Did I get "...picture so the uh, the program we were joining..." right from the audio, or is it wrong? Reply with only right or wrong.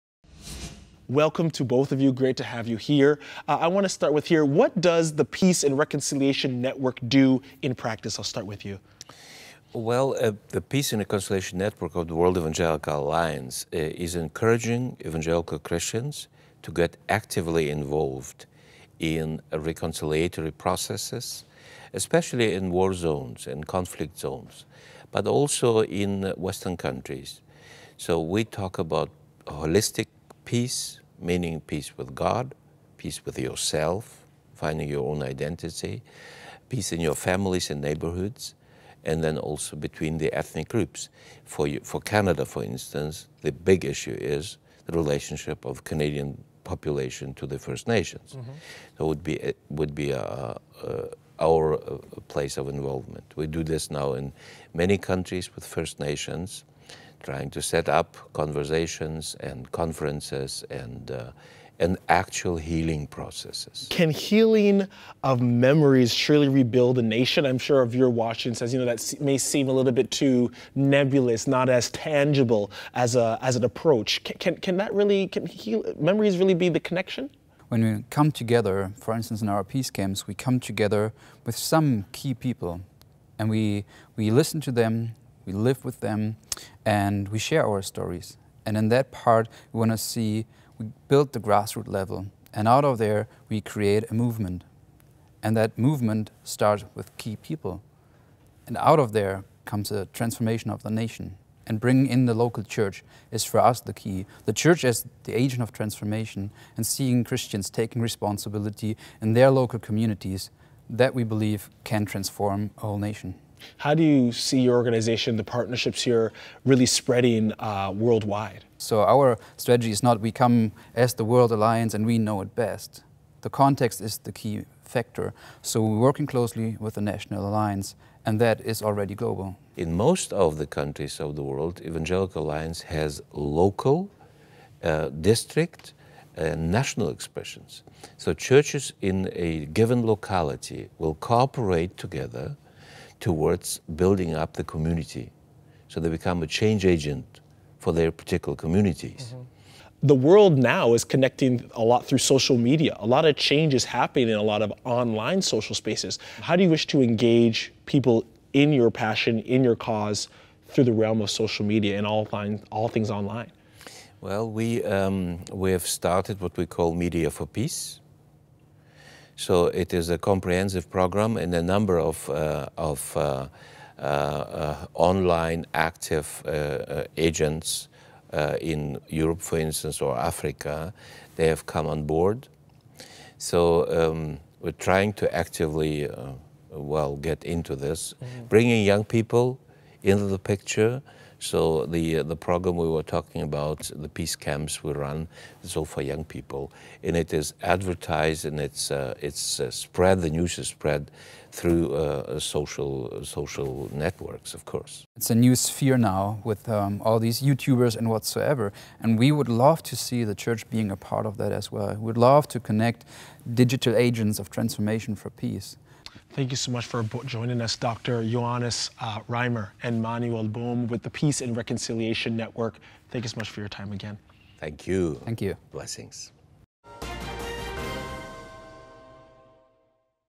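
wrong.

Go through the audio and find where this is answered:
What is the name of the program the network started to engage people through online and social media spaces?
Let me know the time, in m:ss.
2:46.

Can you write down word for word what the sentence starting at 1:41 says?
And bringing in the local church is for us the key.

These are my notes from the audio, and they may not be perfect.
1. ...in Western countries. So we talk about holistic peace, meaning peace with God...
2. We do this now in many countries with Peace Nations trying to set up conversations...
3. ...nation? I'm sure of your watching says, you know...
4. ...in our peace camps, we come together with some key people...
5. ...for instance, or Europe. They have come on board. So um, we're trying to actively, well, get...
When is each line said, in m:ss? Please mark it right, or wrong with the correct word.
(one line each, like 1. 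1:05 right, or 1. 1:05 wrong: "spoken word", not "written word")
1. 0:25 right
2. 0:53 wrong: "First", not "Peace"
3. 1:07 right
4. 1:19 right
5. 2:59 wrong: "Africa", not "Europe".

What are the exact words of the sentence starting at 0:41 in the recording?
For, you, for Canada, for instance, the big issue is the relationship of Canadian population to the First Nations.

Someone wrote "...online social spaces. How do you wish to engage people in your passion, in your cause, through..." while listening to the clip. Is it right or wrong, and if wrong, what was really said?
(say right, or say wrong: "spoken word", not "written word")
right.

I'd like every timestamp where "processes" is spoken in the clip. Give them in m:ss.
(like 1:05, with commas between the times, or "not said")
0:20, 1:03.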